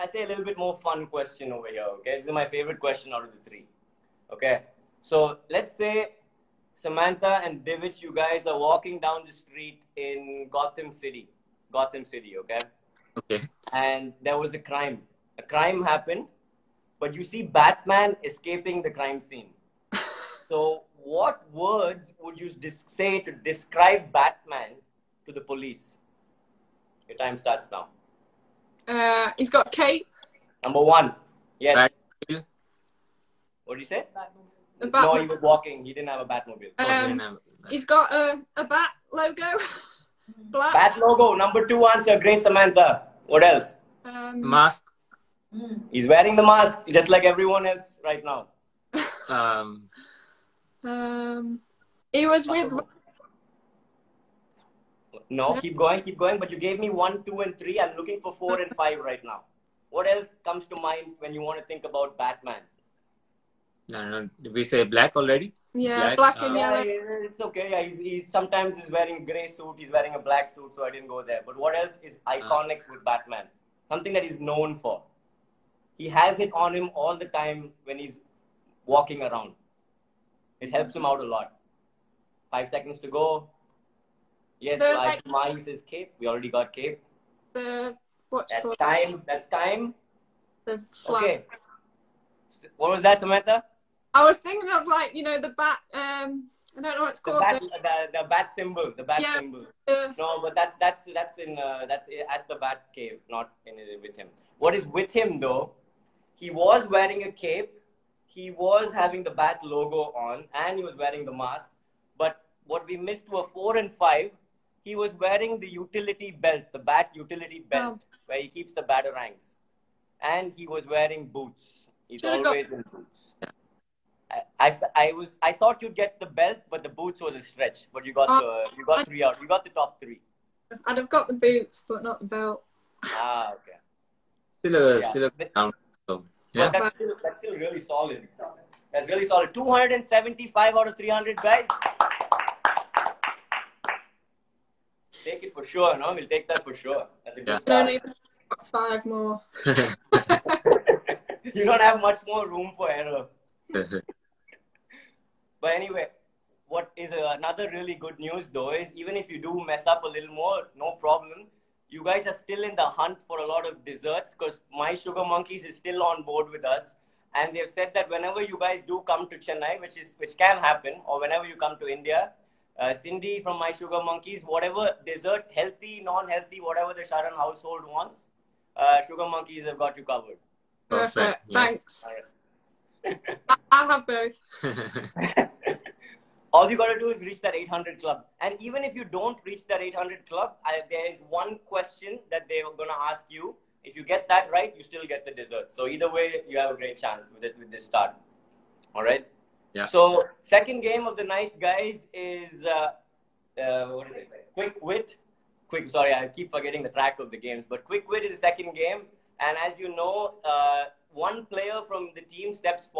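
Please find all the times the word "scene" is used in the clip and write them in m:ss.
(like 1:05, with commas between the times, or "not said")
0:19.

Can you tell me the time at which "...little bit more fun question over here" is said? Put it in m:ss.
0:00.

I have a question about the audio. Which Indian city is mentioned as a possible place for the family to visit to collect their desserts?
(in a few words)
Chennai.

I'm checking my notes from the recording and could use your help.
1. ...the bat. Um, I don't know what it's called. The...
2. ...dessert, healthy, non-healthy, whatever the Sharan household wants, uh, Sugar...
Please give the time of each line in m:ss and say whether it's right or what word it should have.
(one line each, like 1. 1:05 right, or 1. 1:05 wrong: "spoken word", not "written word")
1. 1:35 right
2. 2:55 right.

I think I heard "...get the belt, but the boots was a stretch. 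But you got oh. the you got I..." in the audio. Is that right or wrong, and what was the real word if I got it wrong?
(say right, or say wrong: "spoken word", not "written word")
right.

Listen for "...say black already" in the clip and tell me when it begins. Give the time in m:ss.
1:04.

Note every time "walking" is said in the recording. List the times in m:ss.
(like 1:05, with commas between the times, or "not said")
0:08, 0:35, 1:18.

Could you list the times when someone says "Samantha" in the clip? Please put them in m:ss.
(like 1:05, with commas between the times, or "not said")
0:06, 0:42, 1:33.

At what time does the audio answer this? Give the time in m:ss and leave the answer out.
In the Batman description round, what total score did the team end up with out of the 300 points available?
2:19.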